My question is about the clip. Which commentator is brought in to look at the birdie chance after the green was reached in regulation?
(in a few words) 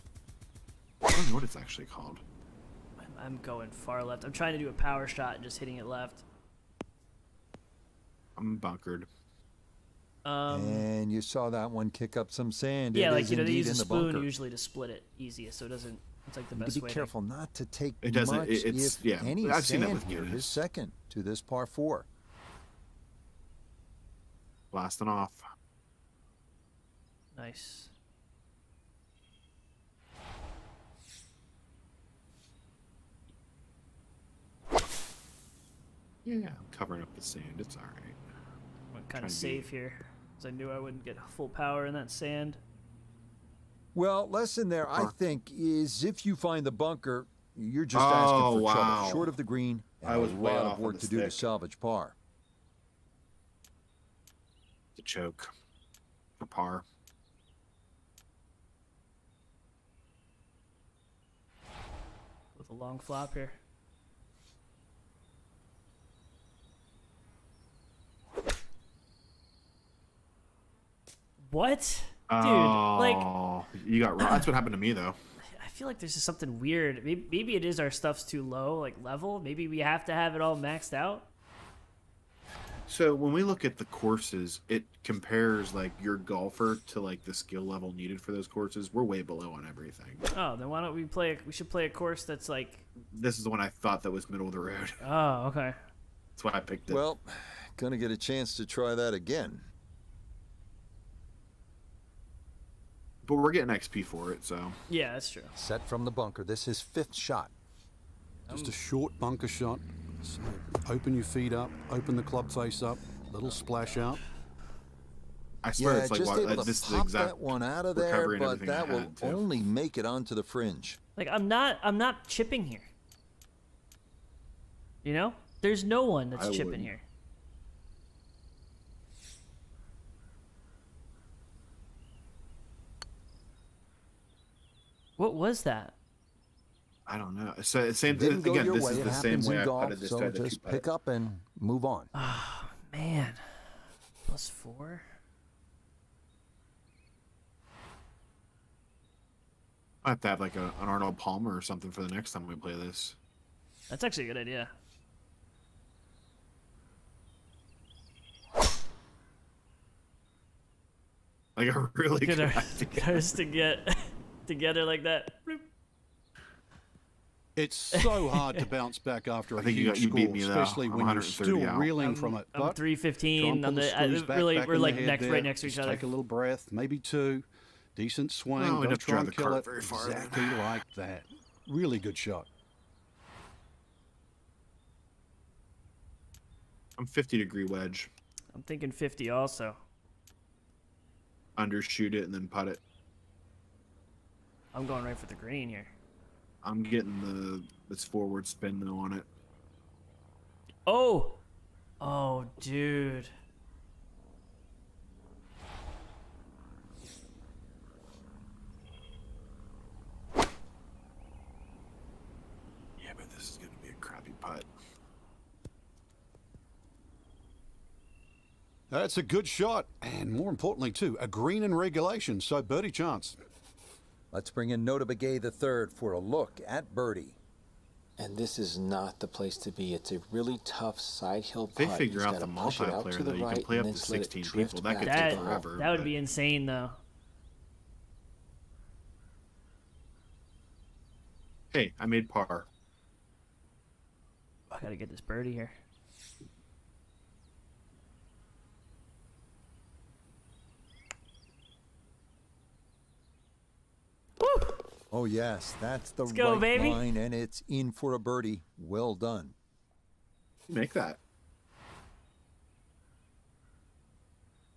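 Notah Begay III.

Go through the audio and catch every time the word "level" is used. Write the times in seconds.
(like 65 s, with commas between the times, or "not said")
79 s, 87 s.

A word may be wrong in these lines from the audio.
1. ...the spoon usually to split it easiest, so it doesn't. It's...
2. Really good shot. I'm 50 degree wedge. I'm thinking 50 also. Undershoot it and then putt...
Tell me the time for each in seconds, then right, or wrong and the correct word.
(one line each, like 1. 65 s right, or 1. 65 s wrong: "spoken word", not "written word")
1. 13 s right
2. 181 s right.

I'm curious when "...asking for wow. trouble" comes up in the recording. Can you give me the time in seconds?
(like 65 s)
48 s.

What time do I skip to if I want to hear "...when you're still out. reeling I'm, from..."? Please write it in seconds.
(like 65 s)
170 s.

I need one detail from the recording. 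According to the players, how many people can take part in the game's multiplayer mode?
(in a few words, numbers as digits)
16.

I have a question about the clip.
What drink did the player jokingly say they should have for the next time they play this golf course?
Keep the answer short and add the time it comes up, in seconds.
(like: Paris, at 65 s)
Arnold Palmer, at 150 s.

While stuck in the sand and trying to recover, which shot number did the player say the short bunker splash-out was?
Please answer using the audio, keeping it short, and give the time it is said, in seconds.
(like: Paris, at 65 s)
5th, at 106 s.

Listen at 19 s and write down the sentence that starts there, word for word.
I've seen that with His second to this par four.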